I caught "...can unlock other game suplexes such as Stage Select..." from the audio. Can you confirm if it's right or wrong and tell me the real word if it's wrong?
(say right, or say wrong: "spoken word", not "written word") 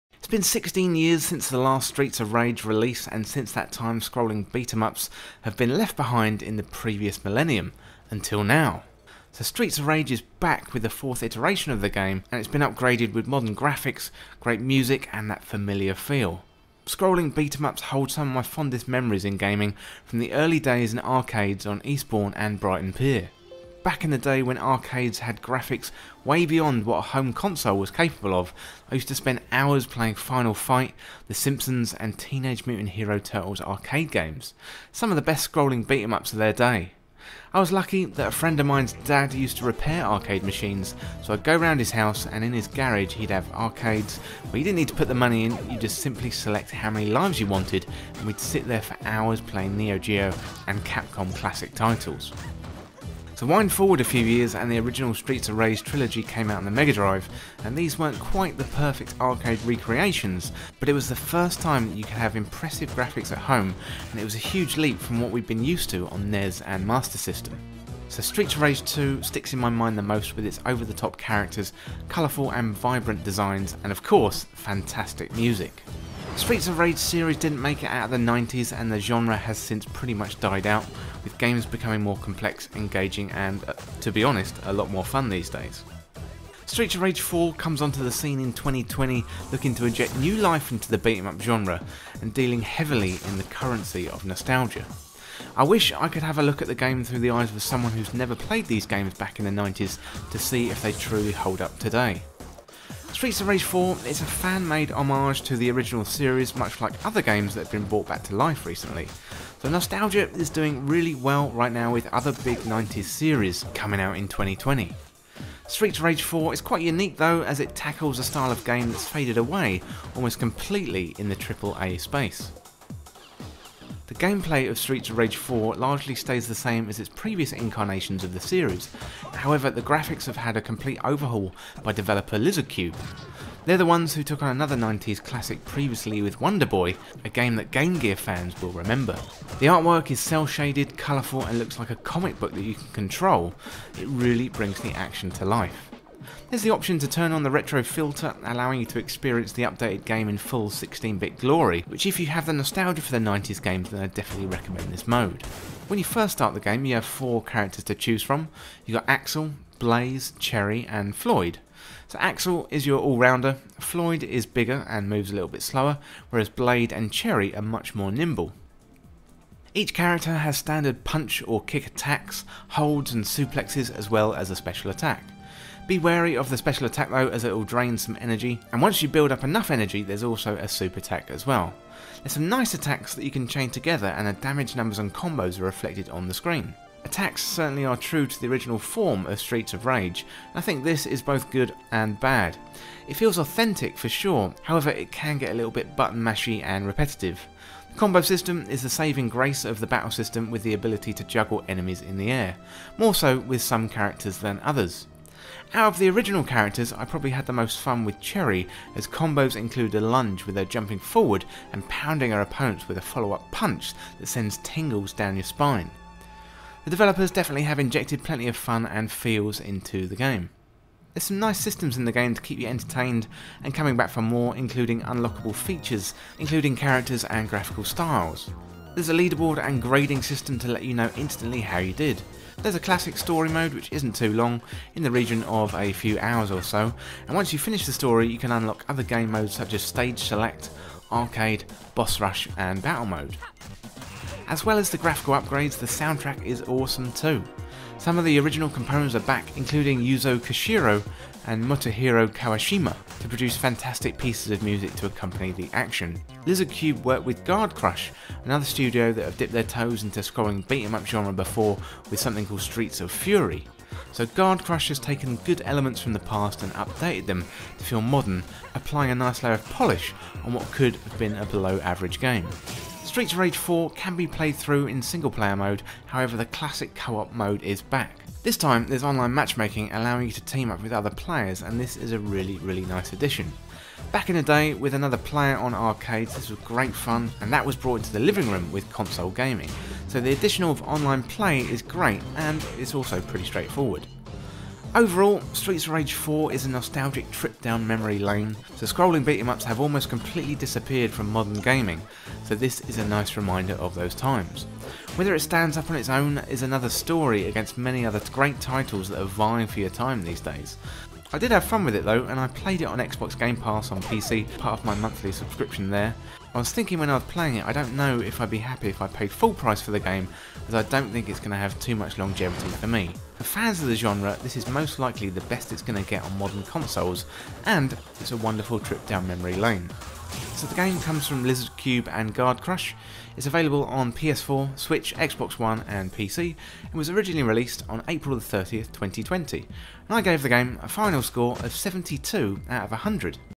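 wrong: "modes", not "suplexes".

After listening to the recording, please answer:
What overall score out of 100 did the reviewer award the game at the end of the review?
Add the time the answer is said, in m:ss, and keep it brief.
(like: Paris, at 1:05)
72, at 5:41.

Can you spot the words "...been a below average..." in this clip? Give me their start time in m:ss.
4:31.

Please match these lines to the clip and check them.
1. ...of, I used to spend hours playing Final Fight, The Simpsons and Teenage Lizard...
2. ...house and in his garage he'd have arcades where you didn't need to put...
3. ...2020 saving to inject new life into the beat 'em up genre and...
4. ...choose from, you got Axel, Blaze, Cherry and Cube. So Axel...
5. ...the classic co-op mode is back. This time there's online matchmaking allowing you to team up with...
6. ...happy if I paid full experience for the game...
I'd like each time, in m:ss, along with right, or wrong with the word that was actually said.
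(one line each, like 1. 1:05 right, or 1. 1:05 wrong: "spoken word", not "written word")
1. 0:28 wrong: "Mutant", not "Lizard"
2. 0:41 right
3. 1:28 wrong: "looking", not "saving"
4. 2:37 wrong: "Floyd", not "Cube"
5. 4:36 right
6. 5:18 wrong: "price", not "experience".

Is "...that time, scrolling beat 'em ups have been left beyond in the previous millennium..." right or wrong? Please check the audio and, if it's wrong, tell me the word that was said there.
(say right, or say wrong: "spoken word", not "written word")
wrong: "behind", not "beyond".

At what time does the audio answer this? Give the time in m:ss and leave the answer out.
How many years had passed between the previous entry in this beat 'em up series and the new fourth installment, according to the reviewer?
0:00.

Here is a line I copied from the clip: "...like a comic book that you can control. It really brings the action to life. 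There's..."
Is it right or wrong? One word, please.
right.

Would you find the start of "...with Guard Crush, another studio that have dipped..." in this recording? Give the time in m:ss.
4:17.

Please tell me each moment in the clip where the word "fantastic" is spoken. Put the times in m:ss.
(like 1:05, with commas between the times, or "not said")
1:14, 4:13.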